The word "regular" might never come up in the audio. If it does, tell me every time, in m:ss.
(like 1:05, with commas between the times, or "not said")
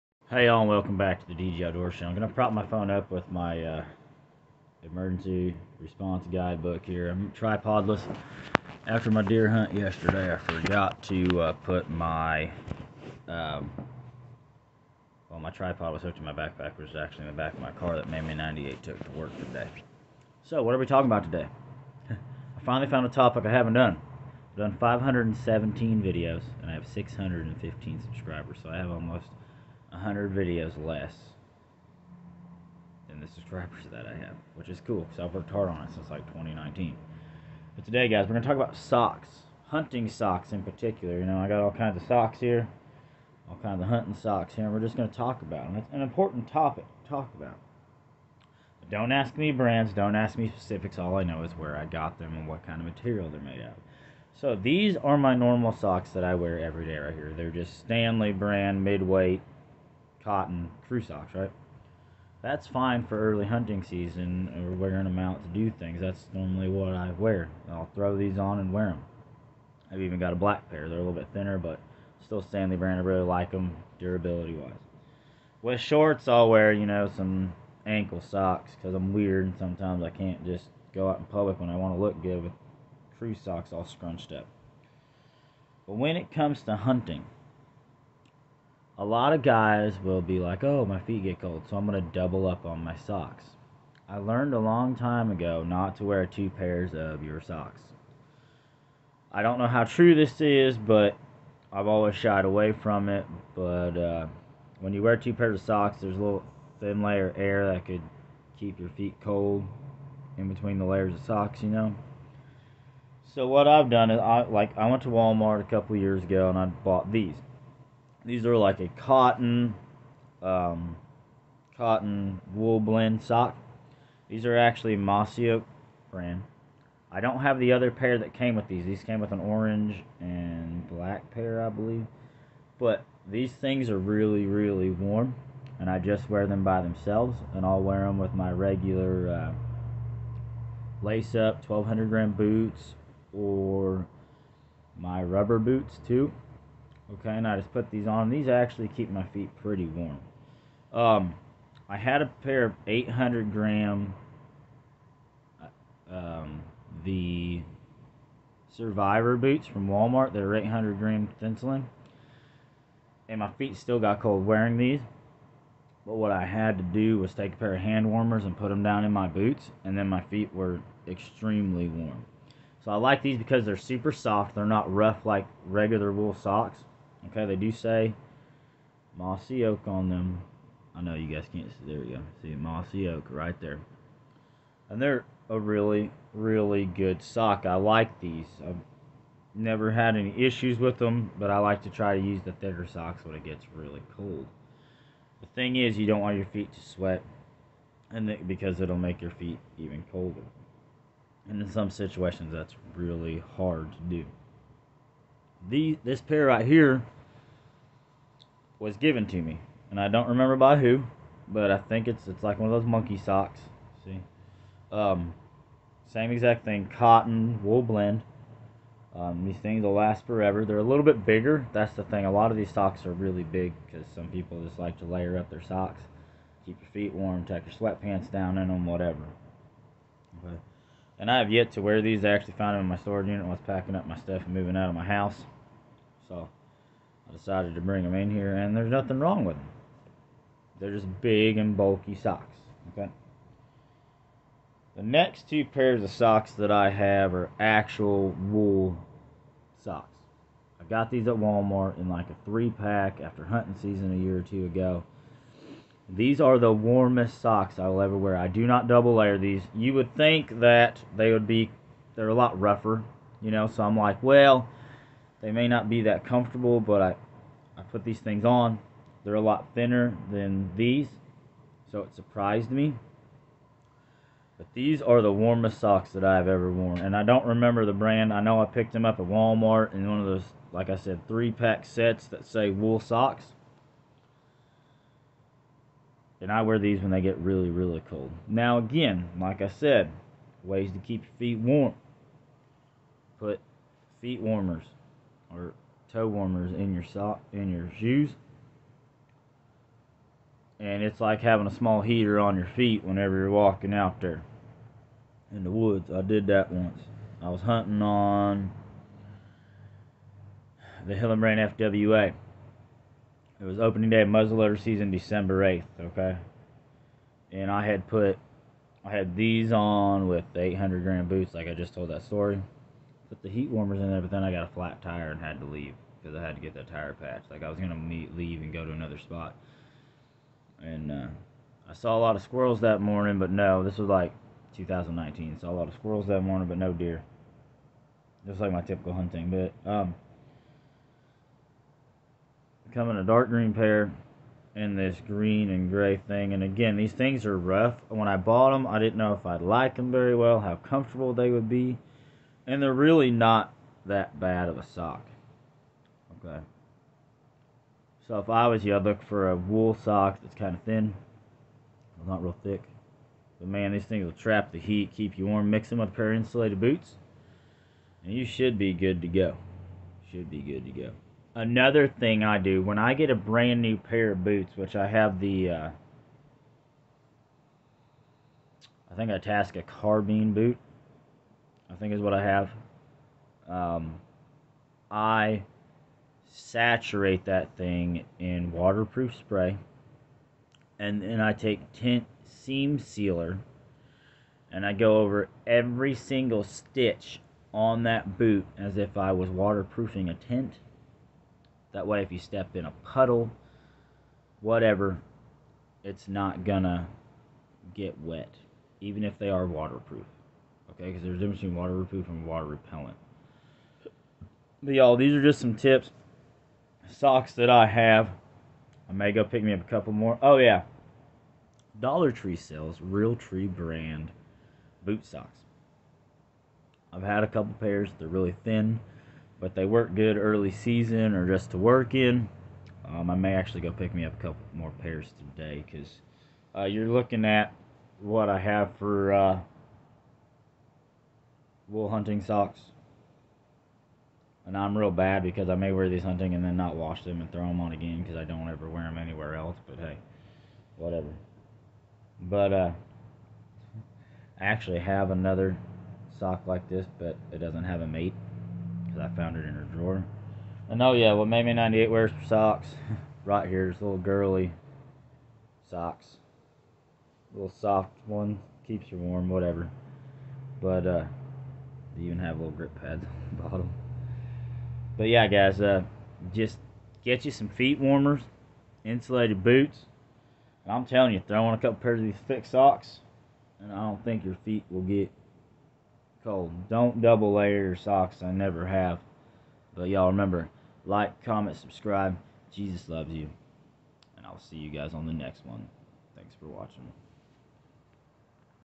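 2:18, 2:55.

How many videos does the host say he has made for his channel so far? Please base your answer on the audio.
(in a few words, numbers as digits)
517.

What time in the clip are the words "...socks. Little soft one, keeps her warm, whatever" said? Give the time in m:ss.
7:45.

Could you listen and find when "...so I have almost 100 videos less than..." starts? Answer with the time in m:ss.
0:28.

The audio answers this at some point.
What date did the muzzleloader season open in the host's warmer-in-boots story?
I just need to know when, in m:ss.
5:15.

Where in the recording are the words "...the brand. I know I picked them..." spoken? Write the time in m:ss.
4:37.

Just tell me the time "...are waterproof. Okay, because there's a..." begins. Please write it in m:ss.
6:49.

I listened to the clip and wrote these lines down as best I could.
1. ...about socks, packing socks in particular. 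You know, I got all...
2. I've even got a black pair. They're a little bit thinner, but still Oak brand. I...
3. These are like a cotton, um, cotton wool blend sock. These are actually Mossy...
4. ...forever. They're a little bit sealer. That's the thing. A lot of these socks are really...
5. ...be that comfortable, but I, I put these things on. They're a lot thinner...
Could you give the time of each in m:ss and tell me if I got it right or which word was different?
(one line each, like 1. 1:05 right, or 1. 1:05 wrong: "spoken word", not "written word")
1. 0:38 wrong: "hunting", not "packing"
2. 1:09 wrong: "Stanley", not "Oak"
3. 1:58 right
4. 3:40 wrong: "bigger", not "sealer"
5. 4:25 right.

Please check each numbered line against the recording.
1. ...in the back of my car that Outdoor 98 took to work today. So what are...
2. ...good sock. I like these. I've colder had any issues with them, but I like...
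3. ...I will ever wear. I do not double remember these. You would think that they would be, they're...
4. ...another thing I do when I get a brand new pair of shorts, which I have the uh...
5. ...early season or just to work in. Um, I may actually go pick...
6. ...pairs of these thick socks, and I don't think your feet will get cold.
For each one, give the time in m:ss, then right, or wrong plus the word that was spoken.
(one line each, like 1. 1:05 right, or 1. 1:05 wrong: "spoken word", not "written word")
1. 0:17 wrong: "Mammy", not "Outdoor"
2. 3:06 wrong: "never", not "colder"
3. 4:17 wrong: "layer", not "remember"
4. 6:11 wrong: "boots", not "shorts"
5. 7:10 right
6. 8:01 right.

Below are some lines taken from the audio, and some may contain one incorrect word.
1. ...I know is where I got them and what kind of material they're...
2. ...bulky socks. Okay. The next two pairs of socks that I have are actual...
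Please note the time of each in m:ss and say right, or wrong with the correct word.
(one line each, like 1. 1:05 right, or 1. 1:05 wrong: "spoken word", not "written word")
1. 0:51 right
2. 4:01 right.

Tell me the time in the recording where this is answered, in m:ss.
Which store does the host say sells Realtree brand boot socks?
7:01.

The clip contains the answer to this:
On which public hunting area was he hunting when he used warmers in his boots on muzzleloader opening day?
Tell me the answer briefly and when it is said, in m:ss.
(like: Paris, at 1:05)
Hillenbrand FWA, at 5:11.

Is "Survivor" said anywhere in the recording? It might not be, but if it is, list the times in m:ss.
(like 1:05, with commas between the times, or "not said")
2:38.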